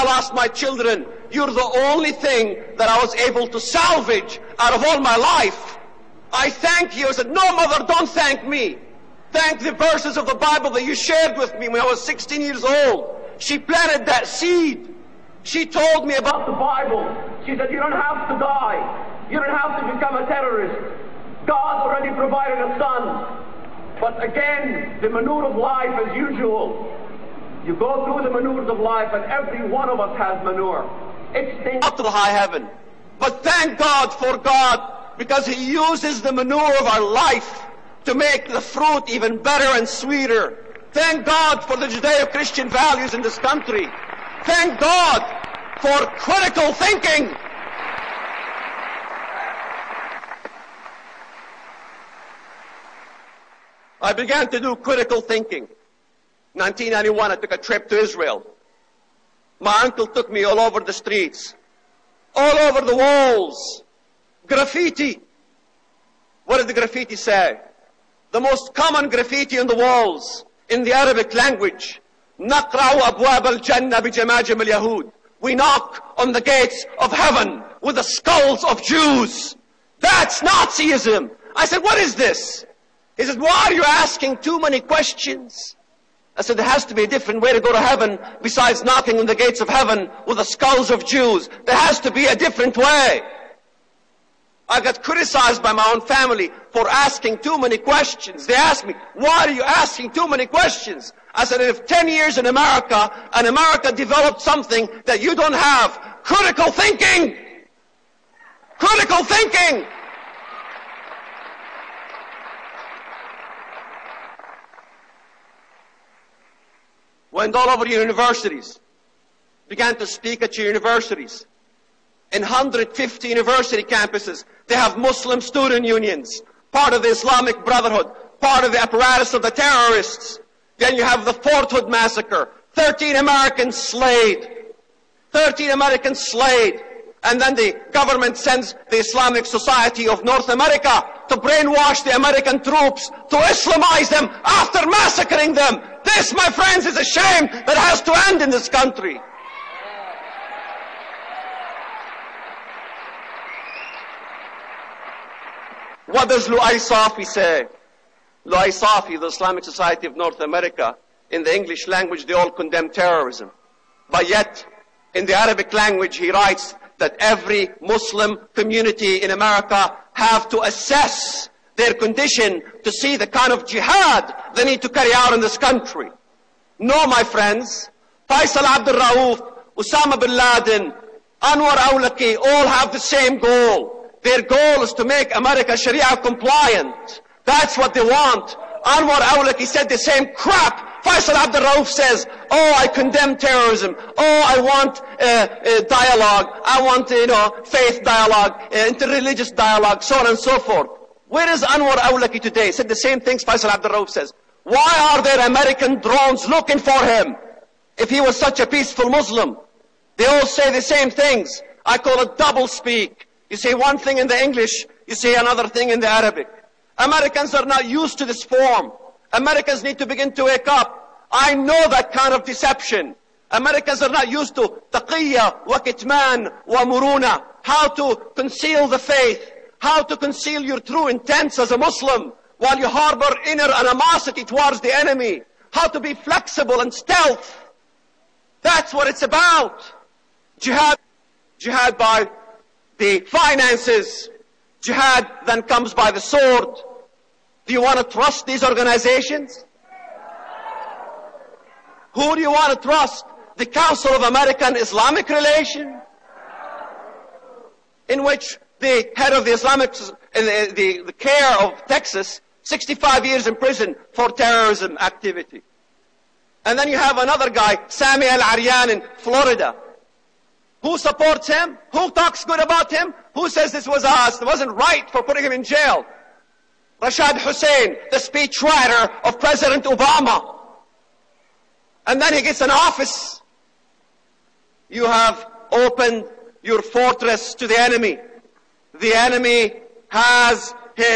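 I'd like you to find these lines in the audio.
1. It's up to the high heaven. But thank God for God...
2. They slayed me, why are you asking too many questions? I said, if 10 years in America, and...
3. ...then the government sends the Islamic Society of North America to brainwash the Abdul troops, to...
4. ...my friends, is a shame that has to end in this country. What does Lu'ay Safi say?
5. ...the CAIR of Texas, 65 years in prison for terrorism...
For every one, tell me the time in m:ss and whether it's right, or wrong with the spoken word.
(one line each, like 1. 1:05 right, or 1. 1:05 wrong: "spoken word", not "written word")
1. 0:31 right
2. 1:38 wrong: "asked", not "slayed"
3. 2:17 wrong: "American", not "Abdul"
4. 2:26 right
5. 4:21 right.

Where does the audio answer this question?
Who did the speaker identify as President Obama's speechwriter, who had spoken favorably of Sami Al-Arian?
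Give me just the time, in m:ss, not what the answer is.
4:36.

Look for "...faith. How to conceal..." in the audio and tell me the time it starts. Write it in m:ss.
3:48.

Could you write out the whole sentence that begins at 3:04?
Their goal is to make America Sharia compliant.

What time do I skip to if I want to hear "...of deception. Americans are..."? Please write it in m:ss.
3:42.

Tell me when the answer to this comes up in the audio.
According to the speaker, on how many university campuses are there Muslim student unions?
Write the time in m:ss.
2:02.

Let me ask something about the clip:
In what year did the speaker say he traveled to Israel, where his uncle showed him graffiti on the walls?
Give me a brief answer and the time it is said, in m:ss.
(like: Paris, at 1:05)
1991, at 0:56.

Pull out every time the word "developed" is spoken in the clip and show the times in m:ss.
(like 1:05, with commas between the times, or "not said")
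1:43.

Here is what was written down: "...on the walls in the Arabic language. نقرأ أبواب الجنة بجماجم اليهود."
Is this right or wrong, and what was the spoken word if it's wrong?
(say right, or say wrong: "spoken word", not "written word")
right.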